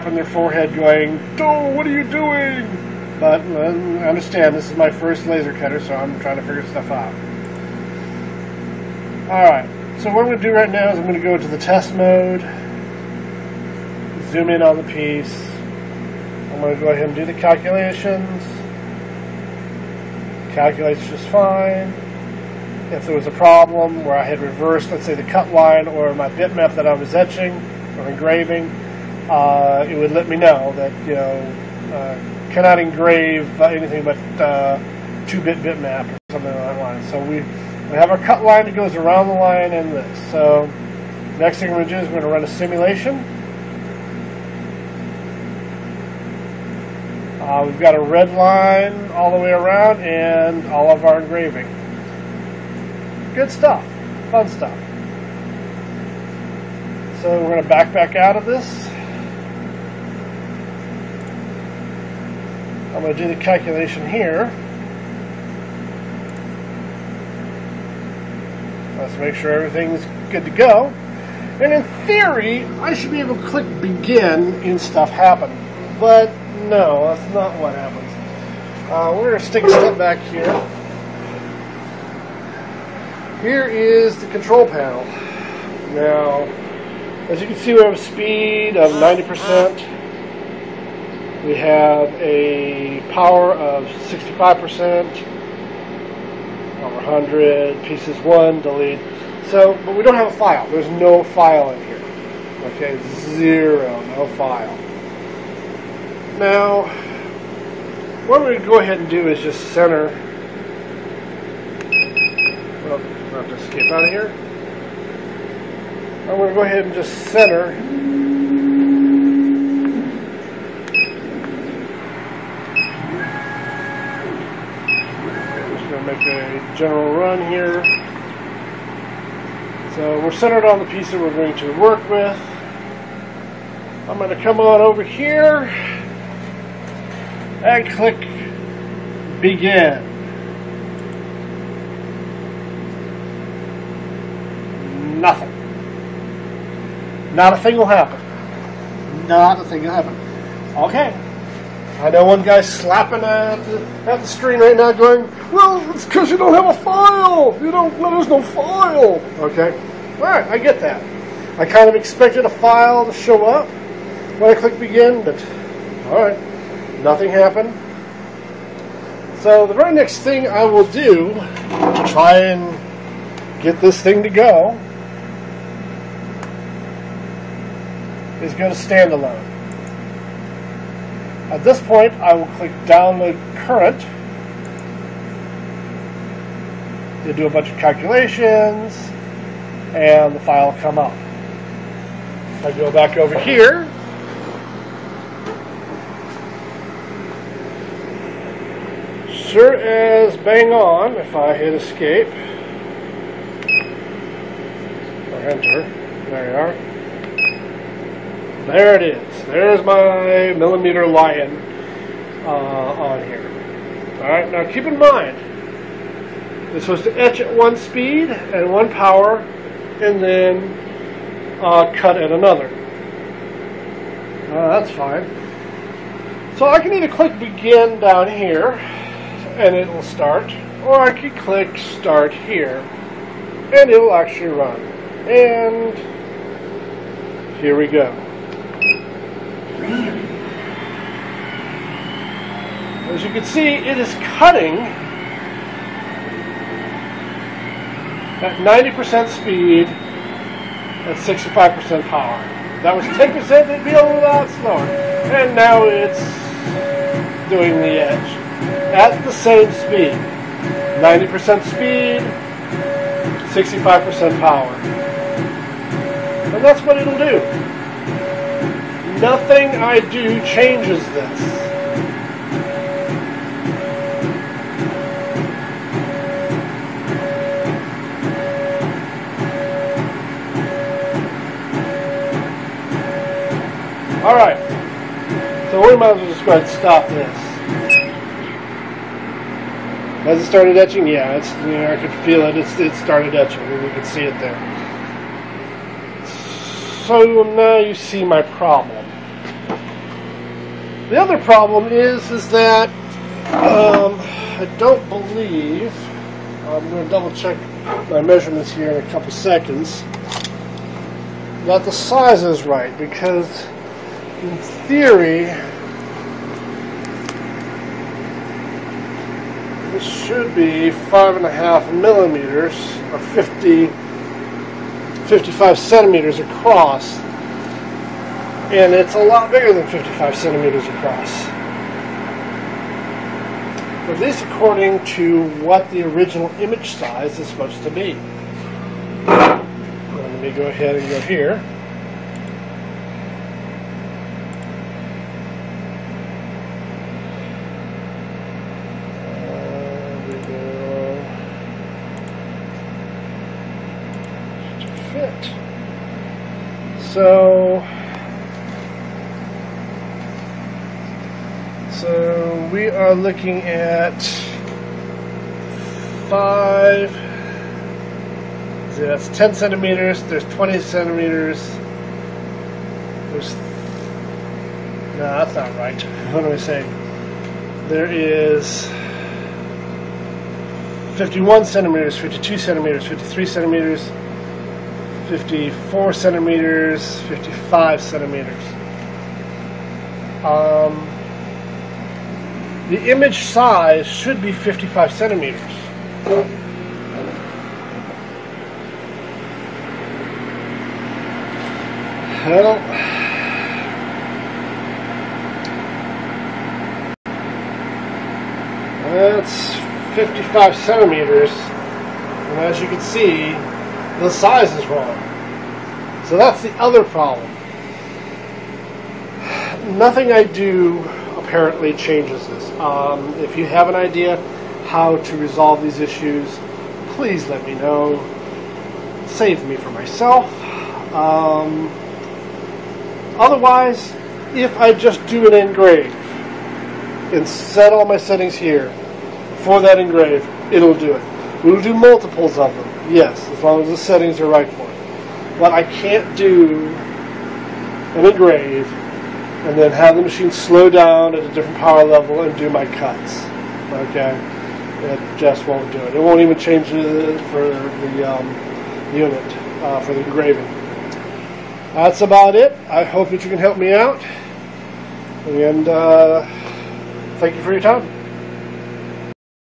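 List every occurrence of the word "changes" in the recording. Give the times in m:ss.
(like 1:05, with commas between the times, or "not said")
4:30, 7:01, 7:36.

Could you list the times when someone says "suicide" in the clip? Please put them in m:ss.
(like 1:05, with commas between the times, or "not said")
not said.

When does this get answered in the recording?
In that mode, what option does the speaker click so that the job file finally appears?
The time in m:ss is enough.
3:02.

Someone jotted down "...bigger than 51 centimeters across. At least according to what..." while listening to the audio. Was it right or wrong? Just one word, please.
wrong.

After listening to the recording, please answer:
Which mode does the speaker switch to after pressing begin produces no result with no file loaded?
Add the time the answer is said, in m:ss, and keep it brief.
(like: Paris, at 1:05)
standalone, at 2:58.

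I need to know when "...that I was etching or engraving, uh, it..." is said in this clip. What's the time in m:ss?
0:26.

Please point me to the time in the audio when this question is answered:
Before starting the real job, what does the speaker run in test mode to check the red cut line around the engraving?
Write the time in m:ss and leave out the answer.
0:42.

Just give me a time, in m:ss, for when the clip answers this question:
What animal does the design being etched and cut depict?
3:31.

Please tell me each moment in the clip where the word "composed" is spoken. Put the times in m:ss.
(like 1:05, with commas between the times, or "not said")
not said.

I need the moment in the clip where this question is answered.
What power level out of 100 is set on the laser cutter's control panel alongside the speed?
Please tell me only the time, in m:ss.
1:33.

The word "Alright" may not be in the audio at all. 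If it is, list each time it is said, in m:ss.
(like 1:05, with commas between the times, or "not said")
0:09, 3:34, 4:44.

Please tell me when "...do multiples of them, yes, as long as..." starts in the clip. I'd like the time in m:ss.
7:21.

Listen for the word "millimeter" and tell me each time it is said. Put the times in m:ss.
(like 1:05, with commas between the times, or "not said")
3:30, 5:21.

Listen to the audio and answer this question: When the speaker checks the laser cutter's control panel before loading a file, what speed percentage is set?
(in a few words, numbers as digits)
90%.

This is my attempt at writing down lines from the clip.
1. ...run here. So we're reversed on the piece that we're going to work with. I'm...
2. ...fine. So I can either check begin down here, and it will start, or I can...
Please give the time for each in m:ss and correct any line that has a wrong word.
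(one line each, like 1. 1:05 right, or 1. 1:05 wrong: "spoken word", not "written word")
1. 2:07 wrong: "centered", not "reversed"
2. 3:44 wrong: "click", not "check".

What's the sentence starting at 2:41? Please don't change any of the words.
I kind of expected a file to show up when I click begin, but all right, nothing happened.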